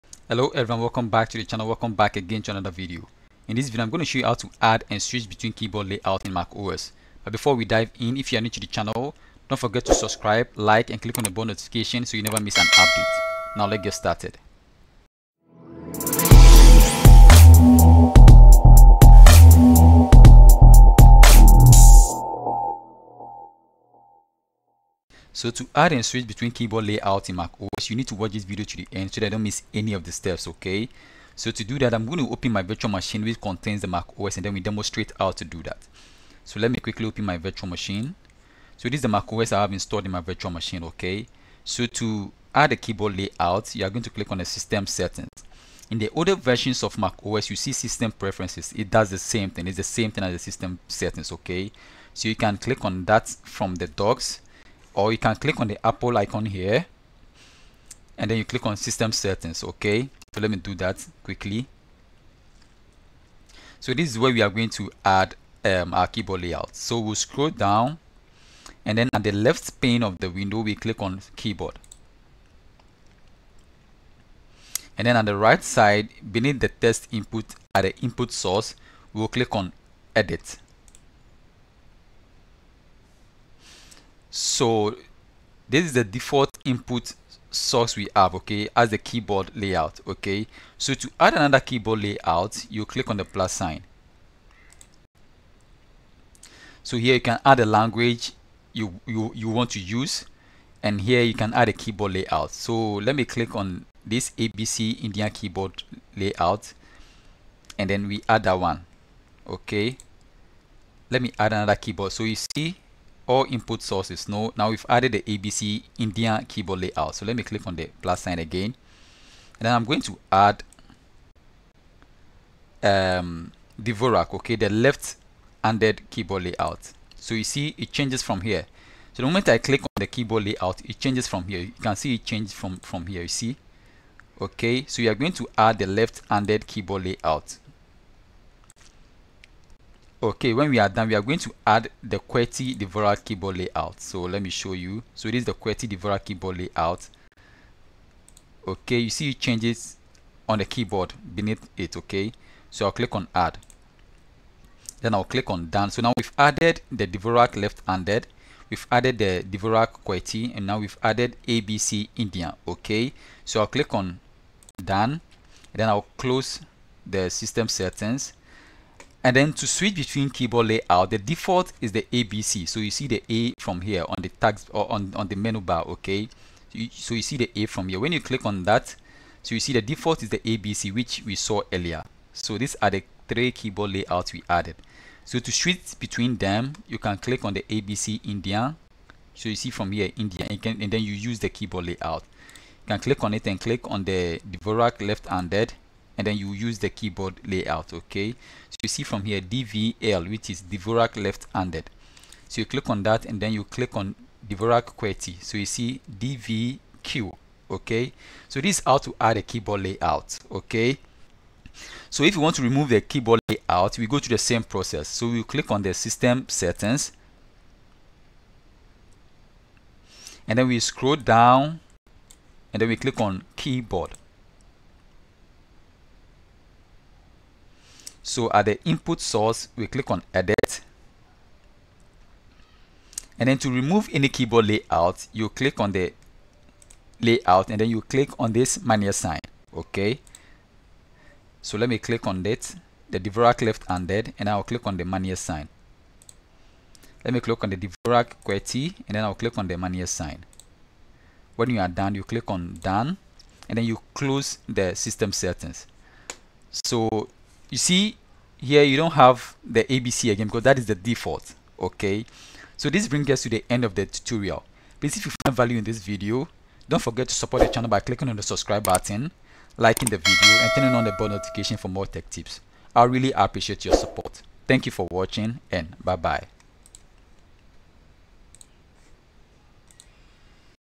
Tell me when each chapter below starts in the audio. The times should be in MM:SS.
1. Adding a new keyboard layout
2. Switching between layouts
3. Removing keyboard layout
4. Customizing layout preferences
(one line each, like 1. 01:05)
1. 00:45
2. 02:15
3. 03:30
4. 04:15.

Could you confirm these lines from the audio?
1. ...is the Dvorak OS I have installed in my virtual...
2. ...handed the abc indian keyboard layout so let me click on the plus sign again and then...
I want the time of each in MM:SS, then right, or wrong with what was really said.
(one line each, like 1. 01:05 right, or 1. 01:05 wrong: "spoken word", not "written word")
1. 00:38 wrong: "Mac", not "Dvorak"
2. 01:54 wrong: "added", not "handed".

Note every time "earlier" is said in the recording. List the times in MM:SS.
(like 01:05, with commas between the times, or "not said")
03:01.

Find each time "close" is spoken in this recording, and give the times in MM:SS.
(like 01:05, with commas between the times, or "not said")
02:46, 04:14.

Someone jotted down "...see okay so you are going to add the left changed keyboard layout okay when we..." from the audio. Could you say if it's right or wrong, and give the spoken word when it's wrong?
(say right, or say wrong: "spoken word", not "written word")
wrong: "handed", not "changed".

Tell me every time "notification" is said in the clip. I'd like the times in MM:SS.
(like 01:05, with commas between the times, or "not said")
00:11, 04:31.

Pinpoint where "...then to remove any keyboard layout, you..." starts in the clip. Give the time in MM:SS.
03:53.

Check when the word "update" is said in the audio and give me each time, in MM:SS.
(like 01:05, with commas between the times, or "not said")
00:12.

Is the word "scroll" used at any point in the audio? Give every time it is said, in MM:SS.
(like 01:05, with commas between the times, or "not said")
01:07, 03:40.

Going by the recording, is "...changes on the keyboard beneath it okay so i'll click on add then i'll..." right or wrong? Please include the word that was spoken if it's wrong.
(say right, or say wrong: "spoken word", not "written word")
right.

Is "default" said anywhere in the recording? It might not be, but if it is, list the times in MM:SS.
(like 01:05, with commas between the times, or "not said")
01:26, 02:51, 02:59, 04:20.